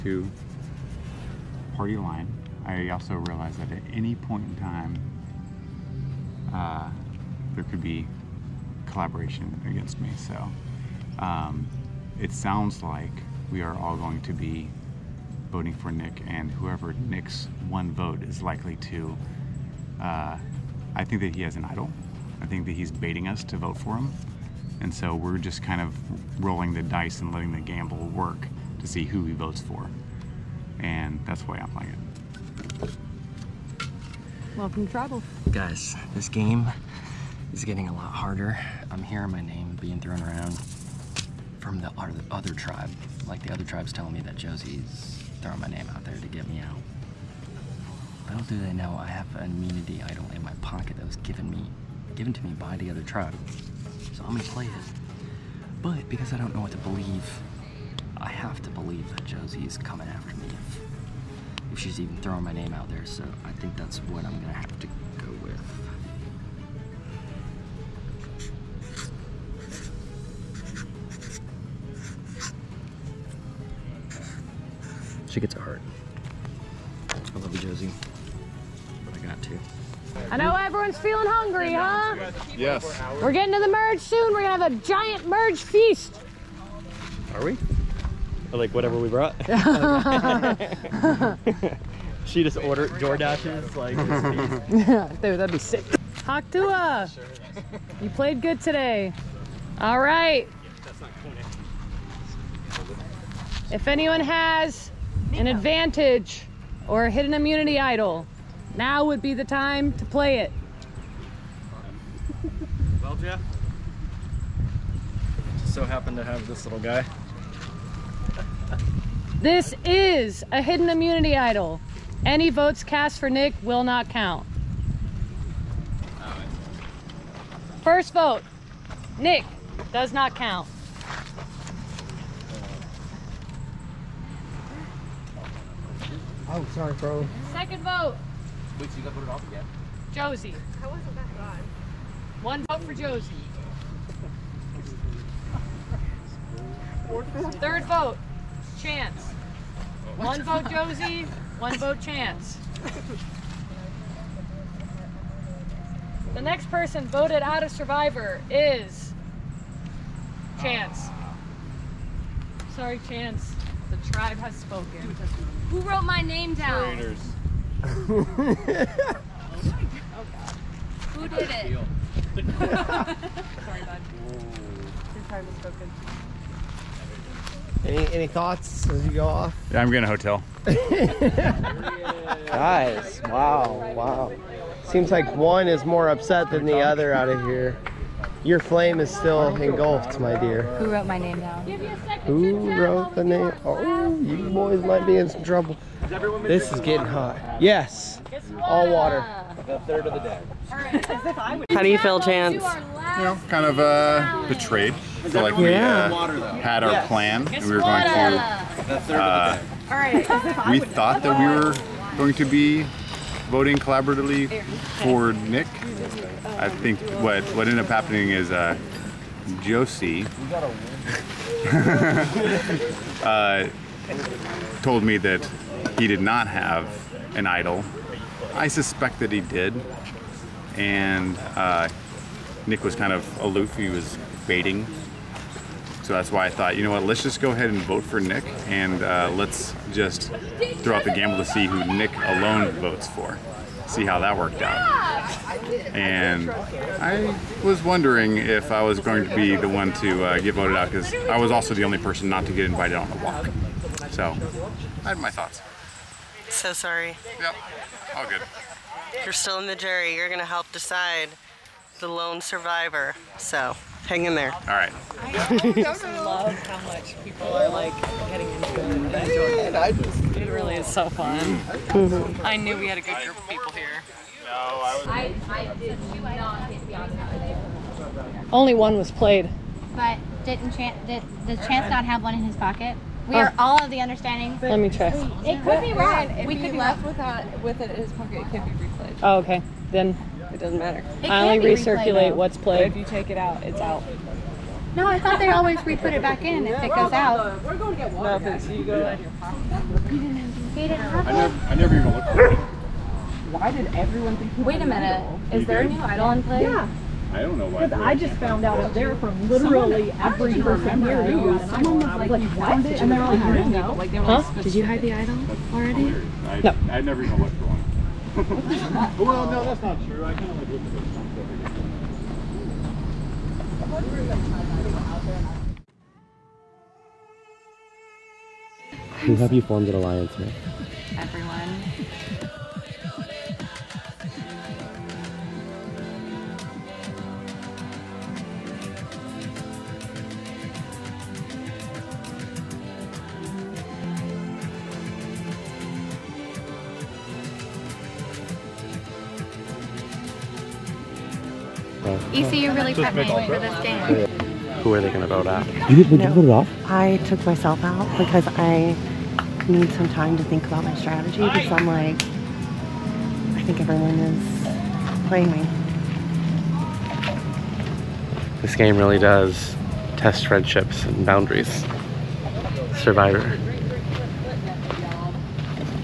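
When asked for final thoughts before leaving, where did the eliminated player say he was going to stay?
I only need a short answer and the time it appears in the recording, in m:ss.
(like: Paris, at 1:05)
A hotel, at 3:00.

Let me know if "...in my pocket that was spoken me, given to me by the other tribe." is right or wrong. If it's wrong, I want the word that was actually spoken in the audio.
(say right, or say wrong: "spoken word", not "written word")
wrong: "given", not "spoken".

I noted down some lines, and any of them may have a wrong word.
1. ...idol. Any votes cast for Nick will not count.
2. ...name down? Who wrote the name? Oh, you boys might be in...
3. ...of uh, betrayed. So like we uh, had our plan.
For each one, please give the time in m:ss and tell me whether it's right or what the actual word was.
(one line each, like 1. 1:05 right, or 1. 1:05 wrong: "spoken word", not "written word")
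1. 2:01 right
2. 3:11 right
3. 3:23 right.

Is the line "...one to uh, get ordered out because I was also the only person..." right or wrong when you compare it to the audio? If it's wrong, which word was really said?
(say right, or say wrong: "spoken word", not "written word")
wrong: "voted", not "ordered".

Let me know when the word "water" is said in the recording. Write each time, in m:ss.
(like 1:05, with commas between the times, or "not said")
3:18, 4:58.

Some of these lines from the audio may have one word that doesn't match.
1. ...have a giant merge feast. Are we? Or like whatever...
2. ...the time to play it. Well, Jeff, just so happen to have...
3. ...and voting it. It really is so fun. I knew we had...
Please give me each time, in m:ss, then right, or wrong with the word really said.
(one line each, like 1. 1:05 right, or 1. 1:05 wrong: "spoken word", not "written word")
1. 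1:24 right
2. 1:49 right
3. 4:28 wrong: "enjoying", not "voting".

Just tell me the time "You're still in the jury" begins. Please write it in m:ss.
4:19.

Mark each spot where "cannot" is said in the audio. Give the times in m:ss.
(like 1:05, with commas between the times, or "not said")
not said.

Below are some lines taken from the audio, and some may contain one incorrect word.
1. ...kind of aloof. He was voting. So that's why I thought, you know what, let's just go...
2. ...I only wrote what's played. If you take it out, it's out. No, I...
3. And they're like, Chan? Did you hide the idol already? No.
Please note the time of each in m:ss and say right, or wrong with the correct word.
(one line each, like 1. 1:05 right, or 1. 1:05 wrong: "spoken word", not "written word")
1. 3:52 wrong: "baiting", not "voting"
2. 4:51 wrong: "recirculate", not "wrote"
3. 5:12 wrong: "Huh", not "Chan".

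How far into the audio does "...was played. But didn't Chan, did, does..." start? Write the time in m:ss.
4:38.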